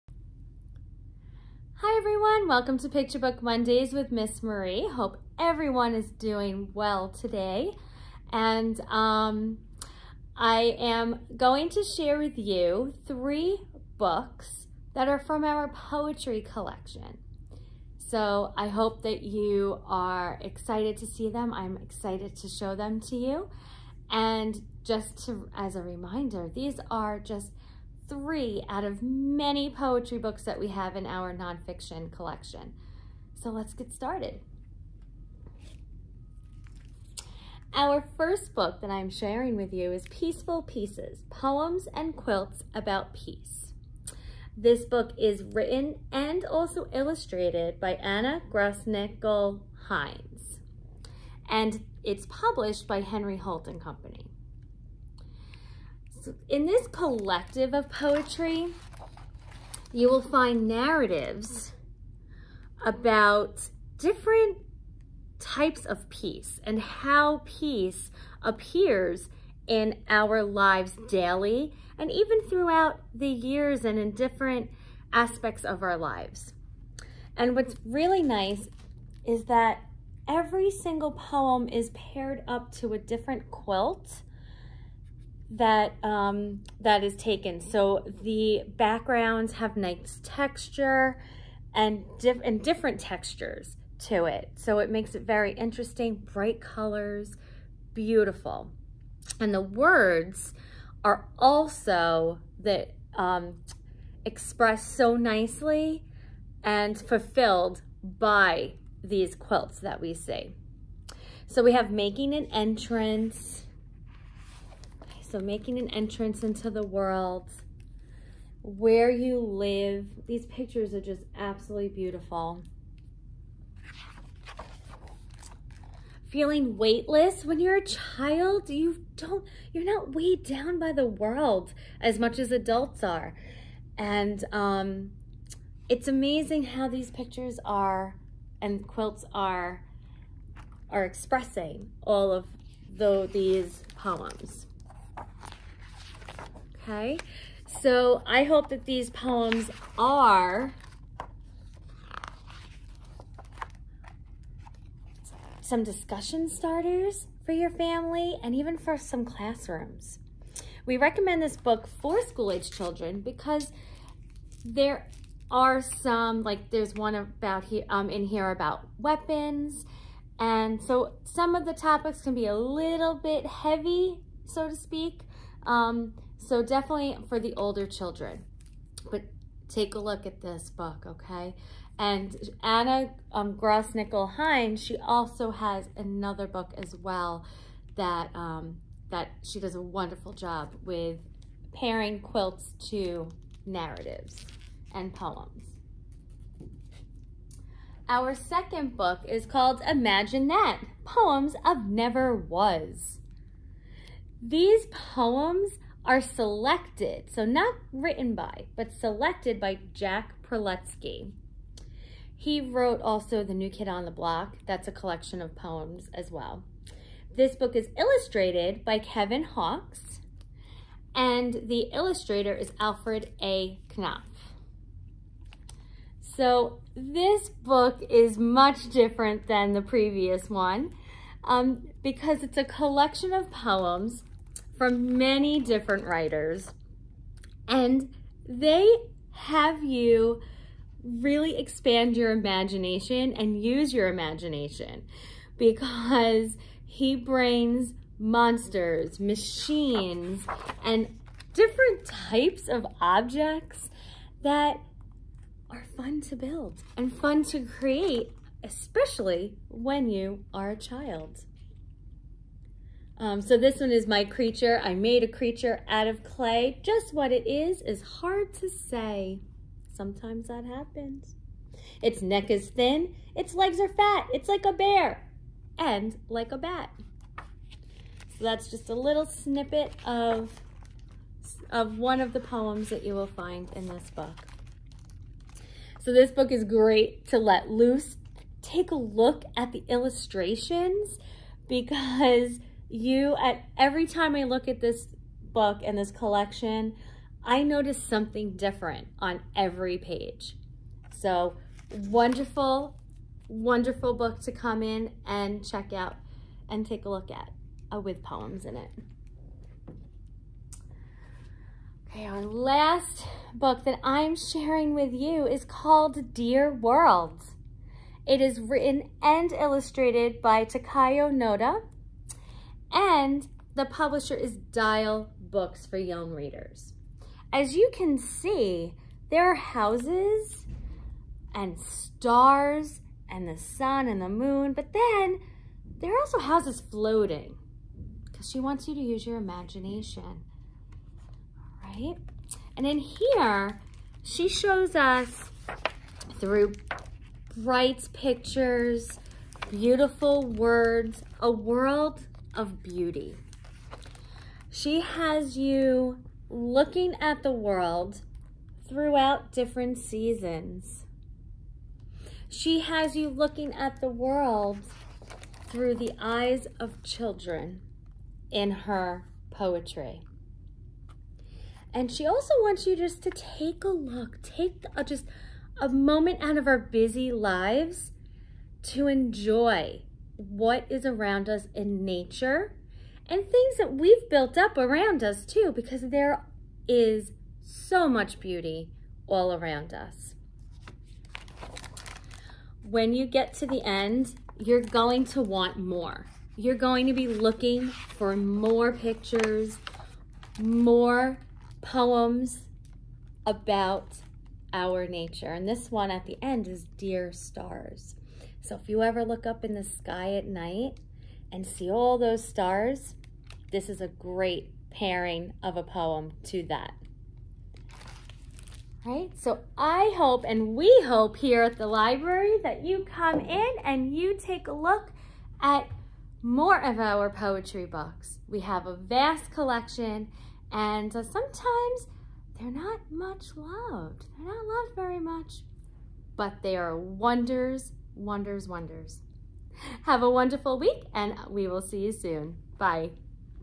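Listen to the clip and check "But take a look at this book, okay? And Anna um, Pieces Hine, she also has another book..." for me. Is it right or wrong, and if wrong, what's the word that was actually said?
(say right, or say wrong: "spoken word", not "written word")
wrong: "Grossnickle", not "Pieces".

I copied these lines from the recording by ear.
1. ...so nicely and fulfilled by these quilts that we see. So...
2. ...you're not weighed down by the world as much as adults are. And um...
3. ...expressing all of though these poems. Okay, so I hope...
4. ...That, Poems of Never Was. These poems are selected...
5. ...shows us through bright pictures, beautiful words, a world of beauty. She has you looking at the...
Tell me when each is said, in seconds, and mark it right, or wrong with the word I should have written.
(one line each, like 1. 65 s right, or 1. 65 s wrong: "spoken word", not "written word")
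1. 104 s right
2. 129 s right
3. 141 s right
4. 200 s right
5. 344 s right.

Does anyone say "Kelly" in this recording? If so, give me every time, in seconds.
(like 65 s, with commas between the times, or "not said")
not said.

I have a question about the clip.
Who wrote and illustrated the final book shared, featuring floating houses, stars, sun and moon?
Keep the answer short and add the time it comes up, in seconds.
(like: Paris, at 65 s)
Takayo Noda, at 320 s.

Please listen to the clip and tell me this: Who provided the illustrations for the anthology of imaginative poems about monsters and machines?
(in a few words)
Kevin Hawkes.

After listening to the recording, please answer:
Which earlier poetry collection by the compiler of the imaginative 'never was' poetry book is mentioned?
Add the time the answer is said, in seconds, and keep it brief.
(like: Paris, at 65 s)
The New Kid on the Block, at 213 s.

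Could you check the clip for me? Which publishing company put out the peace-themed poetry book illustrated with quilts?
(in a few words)
Henry Holt and Company.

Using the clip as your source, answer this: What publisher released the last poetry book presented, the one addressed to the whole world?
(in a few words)
Dial Books for Young Readers.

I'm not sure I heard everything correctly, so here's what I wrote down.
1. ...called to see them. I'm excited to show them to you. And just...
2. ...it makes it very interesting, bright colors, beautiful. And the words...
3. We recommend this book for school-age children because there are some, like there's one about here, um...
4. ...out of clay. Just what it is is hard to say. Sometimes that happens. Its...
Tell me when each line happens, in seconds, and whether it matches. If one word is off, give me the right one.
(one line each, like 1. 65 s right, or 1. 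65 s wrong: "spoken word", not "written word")
1. 20 s wrong: "excited", not "called"
2. 94 s right
3. 160 s right
4. 265 s right.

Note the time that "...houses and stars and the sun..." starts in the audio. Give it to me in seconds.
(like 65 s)
329 s.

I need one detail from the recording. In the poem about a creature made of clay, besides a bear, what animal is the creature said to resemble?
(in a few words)
bat.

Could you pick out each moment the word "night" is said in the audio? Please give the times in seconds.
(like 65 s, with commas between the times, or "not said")
410 s.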